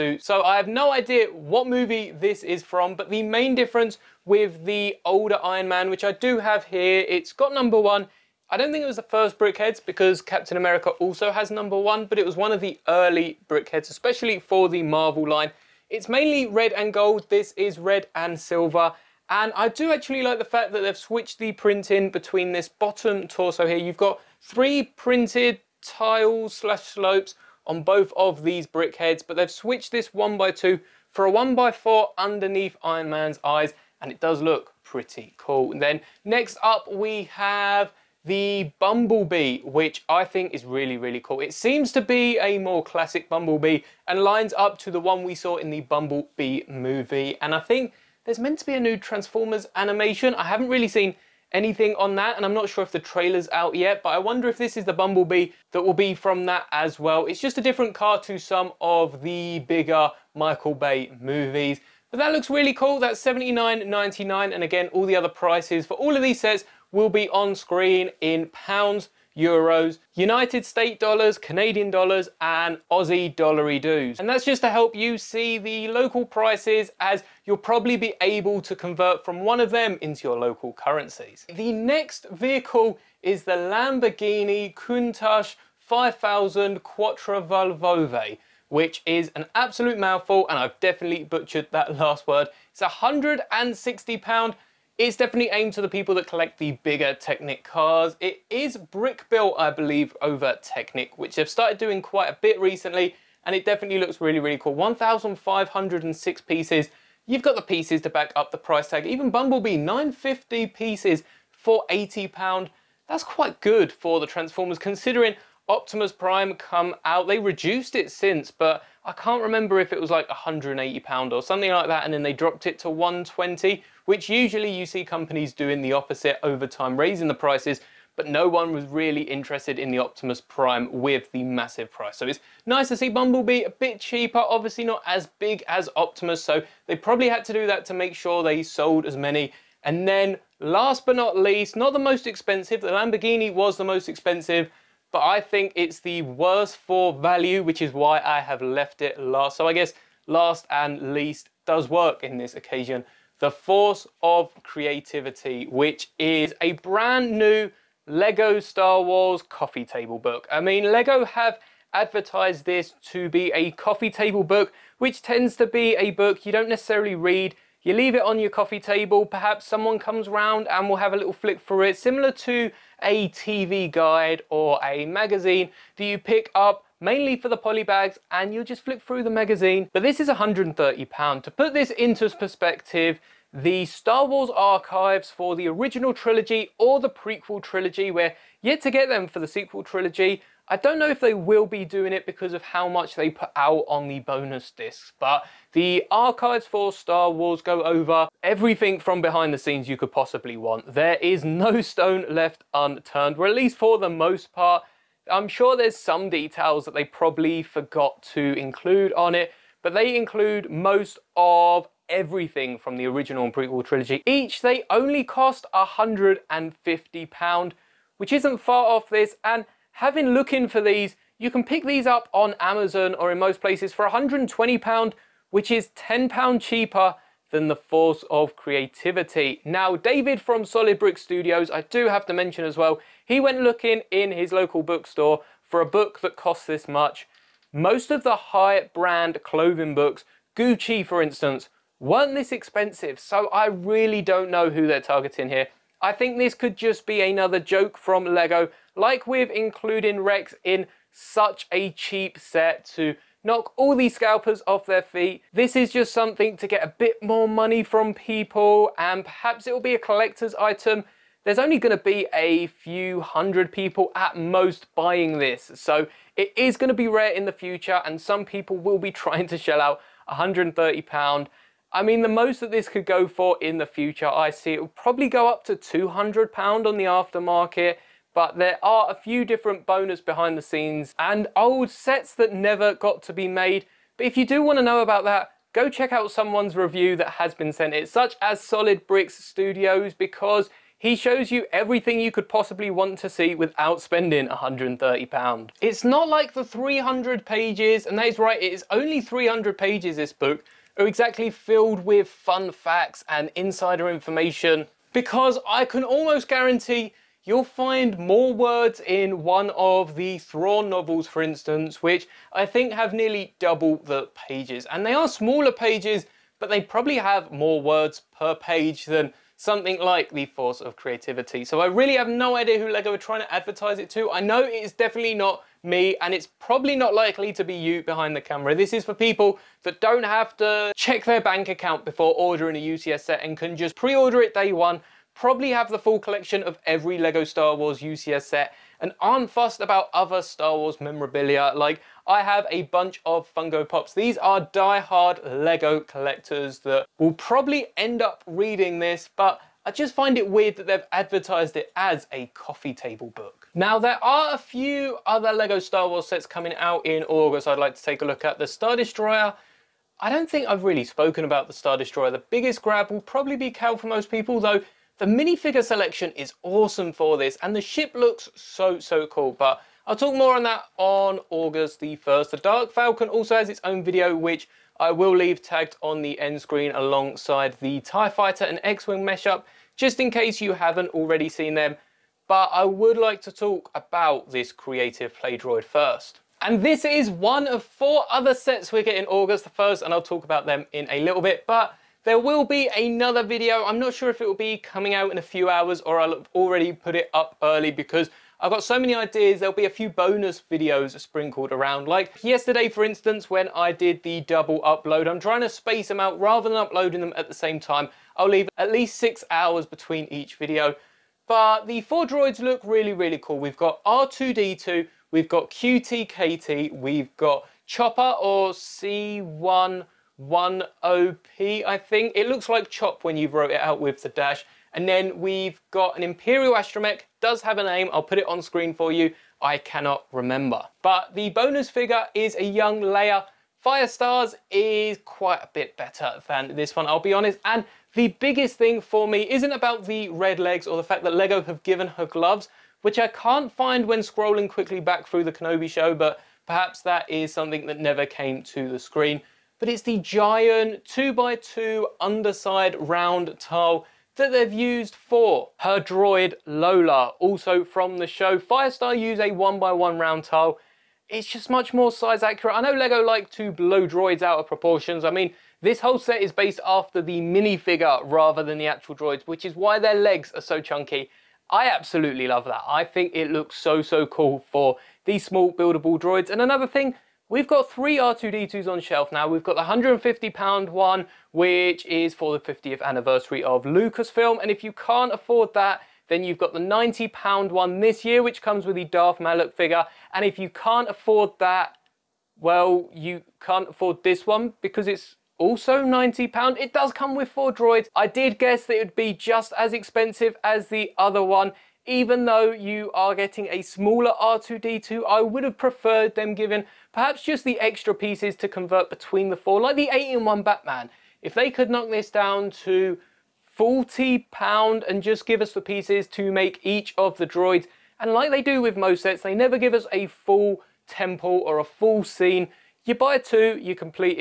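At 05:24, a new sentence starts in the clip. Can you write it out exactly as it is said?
I know it's definitely not me and it's probably not likely to be you behind the camera.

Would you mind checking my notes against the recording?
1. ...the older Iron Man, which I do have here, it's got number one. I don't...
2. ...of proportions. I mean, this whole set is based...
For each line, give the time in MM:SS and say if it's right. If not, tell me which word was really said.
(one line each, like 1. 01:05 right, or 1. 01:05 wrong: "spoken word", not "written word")
1. 00:04 right
2. 07:44 right.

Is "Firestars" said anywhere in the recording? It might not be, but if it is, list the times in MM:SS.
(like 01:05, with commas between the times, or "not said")
07:13, 07:38.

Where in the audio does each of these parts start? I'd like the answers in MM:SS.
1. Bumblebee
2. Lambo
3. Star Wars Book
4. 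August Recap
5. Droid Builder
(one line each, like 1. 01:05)
1. 00:37
2. 01:22
3. 02:32
4. 05:53
5. 06:21.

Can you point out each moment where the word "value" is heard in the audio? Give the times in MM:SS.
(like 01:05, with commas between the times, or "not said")
02:27.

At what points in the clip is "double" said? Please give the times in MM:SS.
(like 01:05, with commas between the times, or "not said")
05:13, 06:44.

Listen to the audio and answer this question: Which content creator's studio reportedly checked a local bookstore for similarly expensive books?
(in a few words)
Solid Brick Studios.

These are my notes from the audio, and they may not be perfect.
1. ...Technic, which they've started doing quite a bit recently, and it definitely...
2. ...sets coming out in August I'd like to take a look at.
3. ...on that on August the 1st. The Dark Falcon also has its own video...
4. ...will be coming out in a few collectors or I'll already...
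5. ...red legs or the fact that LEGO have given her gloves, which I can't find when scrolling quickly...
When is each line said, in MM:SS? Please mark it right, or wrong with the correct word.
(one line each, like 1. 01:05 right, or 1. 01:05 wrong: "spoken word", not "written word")
1. 01:40 right
2. 05:56 right
3. 06:10 right
4. 06:34 wrong: "hours", not "collectors"
5. 07:20 right.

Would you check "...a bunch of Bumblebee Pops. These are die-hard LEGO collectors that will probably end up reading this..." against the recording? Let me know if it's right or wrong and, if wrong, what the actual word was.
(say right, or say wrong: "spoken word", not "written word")
wrong: "Funko", not "Bumblebee".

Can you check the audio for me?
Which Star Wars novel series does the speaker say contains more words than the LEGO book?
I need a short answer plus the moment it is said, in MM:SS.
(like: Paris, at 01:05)
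Thrawn novels, at 05:10.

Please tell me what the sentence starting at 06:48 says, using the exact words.
I'll leave at least six hours between each video.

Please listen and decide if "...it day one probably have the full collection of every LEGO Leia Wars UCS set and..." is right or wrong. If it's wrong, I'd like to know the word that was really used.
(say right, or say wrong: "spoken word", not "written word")
wrong: "Star", not "Leia".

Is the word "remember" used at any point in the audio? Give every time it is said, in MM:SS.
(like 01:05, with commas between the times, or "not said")
01:59, 07:10.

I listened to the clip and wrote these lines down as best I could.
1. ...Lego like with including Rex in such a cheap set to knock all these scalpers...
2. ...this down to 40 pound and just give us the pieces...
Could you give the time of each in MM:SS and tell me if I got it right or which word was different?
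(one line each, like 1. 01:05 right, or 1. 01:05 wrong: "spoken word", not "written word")
1. 04:08 right
2. 08:32 right.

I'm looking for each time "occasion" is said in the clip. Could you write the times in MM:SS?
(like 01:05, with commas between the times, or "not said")
02:32.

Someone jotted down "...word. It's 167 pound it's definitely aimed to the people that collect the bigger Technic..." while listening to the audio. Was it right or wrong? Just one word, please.
wrong.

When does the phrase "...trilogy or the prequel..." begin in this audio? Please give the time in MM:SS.
03:06.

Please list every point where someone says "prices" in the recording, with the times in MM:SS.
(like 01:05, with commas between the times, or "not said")
01:05, 01:16, 01:48, 02:07, 02:11.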